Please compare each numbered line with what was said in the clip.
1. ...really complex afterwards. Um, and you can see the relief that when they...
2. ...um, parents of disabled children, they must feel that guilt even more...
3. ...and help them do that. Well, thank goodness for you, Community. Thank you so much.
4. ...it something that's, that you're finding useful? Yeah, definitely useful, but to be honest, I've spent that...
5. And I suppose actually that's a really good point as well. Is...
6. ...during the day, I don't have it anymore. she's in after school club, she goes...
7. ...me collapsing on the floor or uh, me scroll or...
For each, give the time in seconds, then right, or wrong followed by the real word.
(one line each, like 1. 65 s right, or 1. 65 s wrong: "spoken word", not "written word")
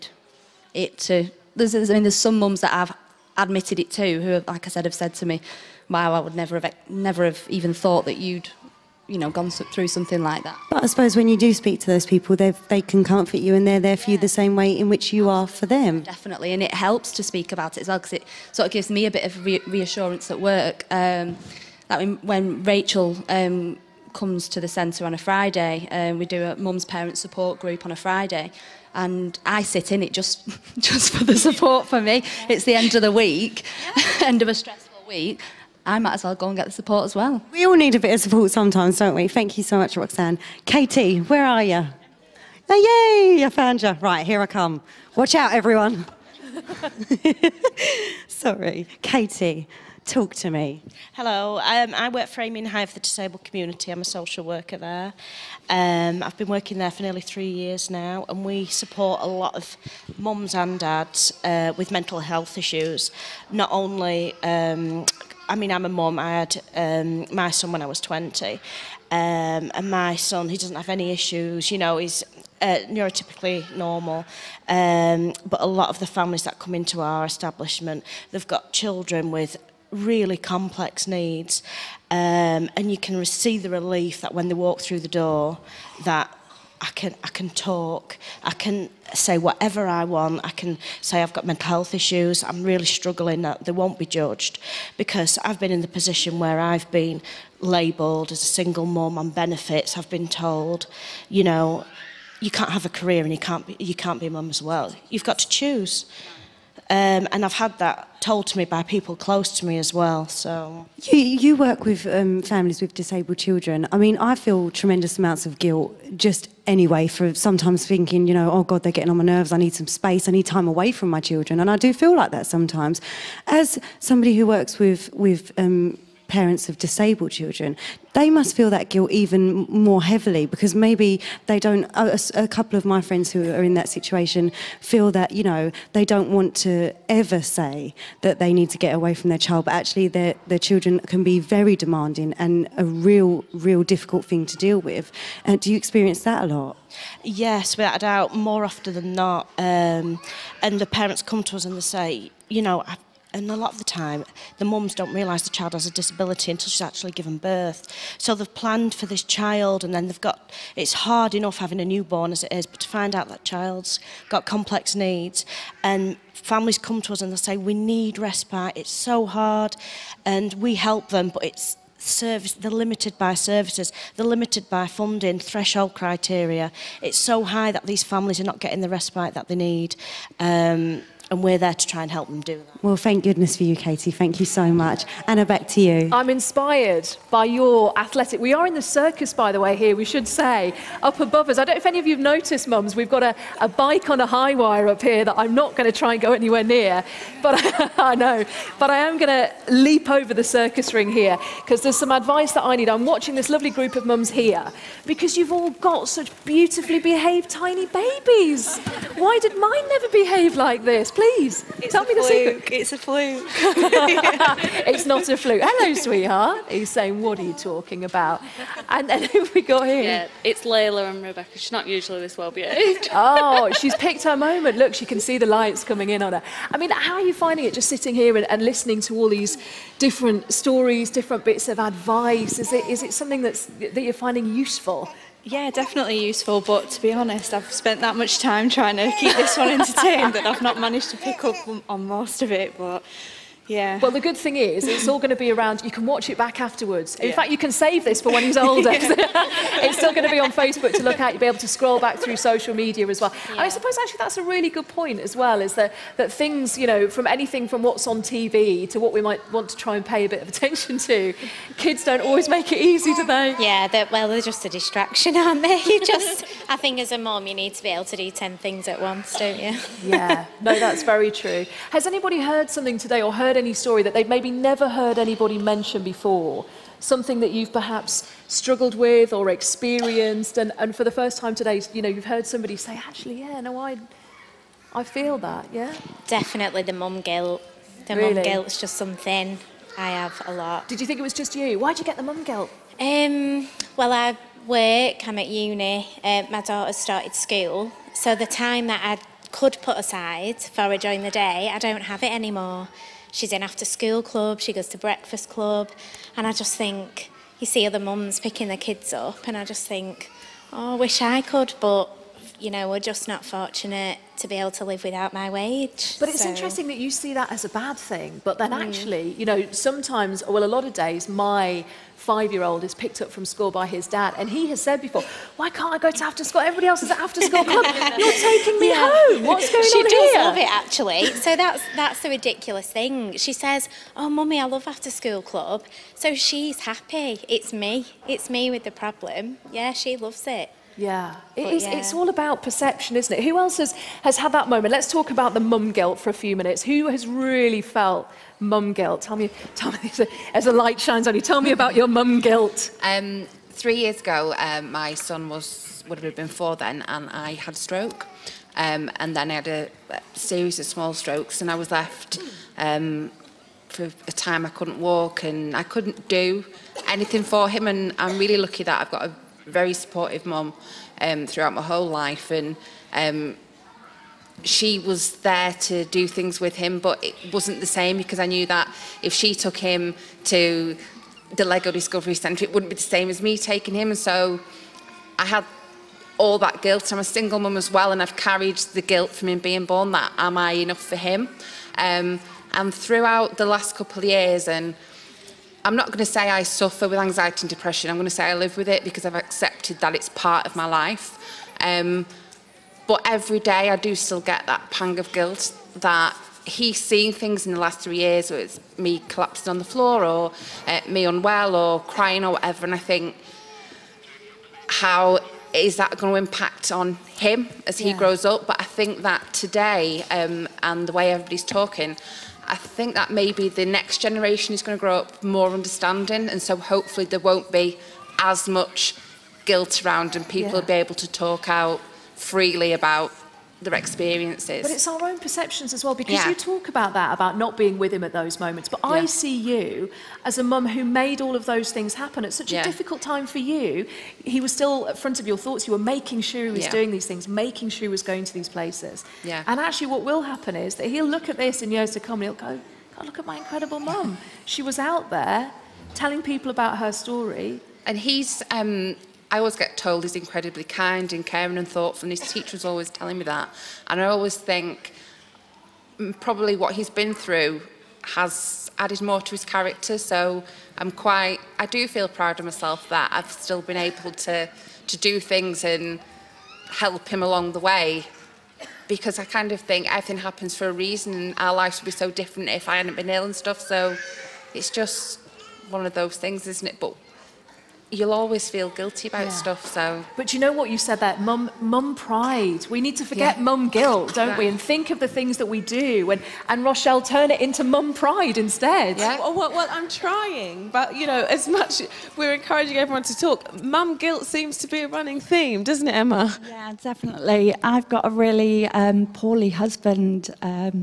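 1. 79 s wrong: "needs", not "afterwards"
2. 125 s right
3. 182 s wrong: "Katie", not "Community"
4. 233 s right
5. 253 s right
6. 300 s right
7. 408 s wrong: "unwell", not "scroll".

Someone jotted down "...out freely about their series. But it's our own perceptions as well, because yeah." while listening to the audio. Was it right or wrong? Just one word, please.
wrong.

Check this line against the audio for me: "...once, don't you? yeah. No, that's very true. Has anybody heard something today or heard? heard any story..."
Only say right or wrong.
right.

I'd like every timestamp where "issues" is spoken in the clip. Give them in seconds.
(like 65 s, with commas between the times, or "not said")
62 s, 71 s, 91 s.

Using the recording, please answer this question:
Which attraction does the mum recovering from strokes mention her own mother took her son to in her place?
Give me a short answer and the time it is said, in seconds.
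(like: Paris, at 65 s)
Lego Discovery Centre, at 381 s.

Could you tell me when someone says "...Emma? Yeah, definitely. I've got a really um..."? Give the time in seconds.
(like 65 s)
506 s.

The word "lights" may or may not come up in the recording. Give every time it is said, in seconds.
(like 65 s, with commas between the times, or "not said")
225 s, 350 s.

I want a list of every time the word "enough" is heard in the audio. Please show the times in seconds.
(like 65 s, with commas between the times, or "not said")
161 s, 390 s.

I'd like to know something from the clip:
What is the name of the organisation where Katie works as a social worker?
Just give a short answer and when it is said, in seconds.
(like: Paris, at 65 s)
Aiming High for the Disabled Community, at 52 s.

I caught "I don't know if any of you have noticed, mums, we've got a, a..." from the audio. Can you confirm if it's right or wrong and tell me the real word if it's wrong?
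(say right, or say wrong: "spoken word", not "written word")
right.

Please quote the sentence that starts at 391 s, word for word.
Um, and throughout the last couple of years, and I'm not going to say I suffer with anxiety and depression.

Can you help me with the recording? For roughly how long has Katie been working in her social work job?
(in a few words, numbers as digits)
nearly three years.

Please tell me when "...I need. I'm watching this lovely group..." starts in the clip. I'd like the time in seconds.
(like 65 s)
202 s.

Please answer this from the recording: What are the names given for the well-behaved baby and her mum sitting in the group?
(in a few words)
Layla and Rebecca.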